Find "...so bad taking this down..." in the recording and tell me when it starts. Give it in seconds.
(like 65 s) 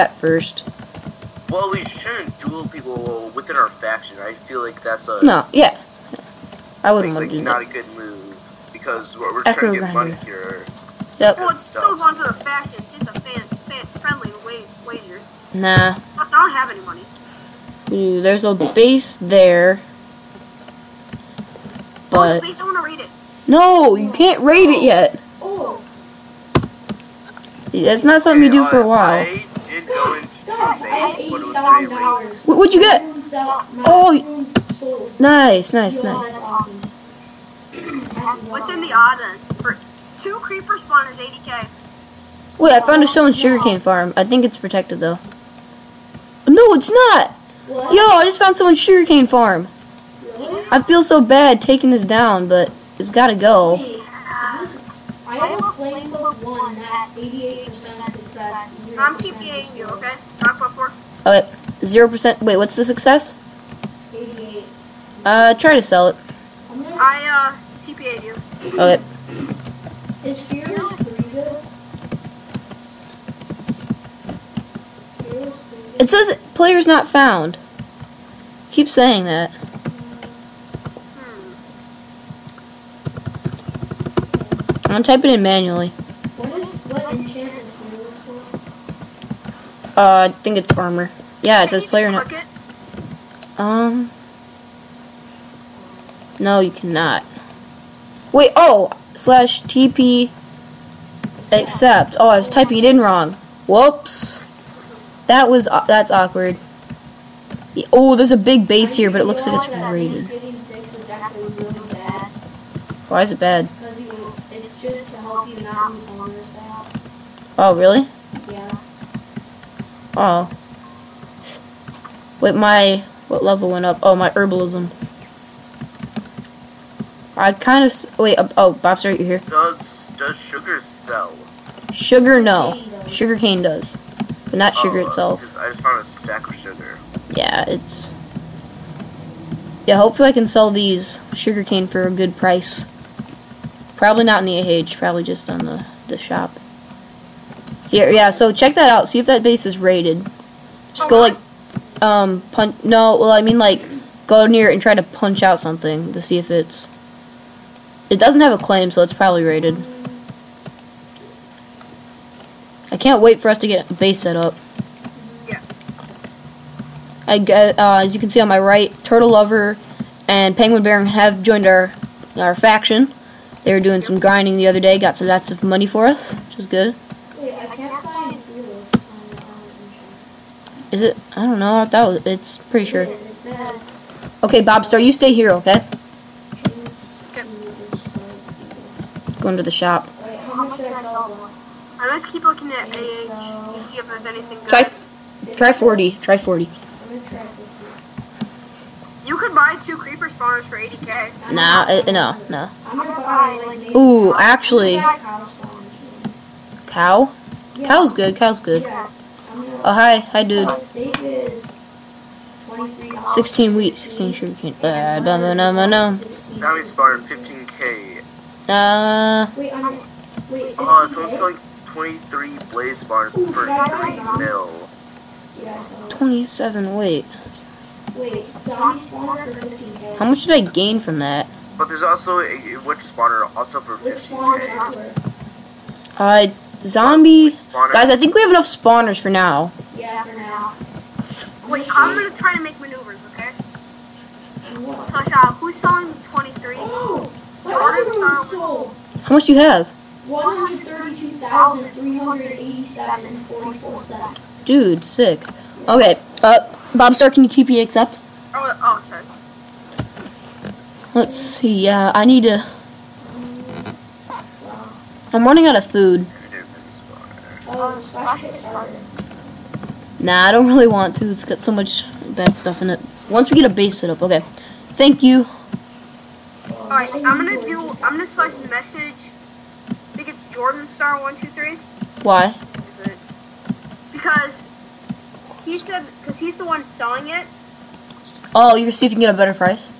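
51 s.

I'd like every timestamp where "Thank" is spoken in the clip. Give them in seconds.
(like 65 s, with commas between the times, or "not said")
274 s.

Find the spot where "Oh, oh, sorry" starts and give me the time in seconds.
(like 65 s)
258 s.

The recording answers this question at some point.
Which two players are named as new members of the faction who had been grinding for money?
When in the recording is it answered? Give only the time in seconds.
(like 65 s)
169 s.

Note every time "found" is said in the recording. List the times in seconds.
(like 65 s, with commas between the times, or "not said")
42 s, 48 s, 77 s, 135 s.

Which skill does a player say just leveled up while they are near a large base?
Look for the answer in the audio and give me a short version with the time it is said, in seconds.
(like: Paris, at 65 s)
Herbalism, at 124 s.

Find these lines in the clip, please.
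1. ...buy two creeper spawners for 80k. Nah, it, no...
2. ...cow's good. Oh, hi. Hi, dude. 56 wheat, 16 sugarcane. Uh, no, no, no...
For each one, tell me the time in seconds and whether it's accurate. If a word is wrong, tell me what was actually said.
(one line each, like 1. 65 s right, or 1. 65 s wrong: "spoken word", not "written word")
1. 199 s right
2. 208 s wrong: "16", not "56".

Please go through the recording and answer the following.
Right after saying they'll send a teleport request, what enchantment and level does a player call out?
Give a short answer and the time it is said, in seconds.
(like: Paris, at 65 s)
Knockback 4, at 60 s.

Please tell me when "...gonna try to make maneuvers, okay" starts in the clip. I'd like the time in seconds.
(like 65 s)
242 s.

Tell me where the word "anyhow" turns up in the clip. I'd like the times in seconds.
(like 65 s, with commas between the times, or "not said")
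not said.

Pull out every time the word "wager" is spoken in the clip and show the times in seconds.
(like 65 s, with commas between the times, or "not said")
14 s.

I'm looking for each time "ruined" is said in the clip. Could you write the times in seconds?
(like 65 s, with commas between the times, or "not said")
not said.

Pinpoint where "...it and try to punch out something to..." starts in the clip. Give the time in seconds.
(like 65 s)
154 s.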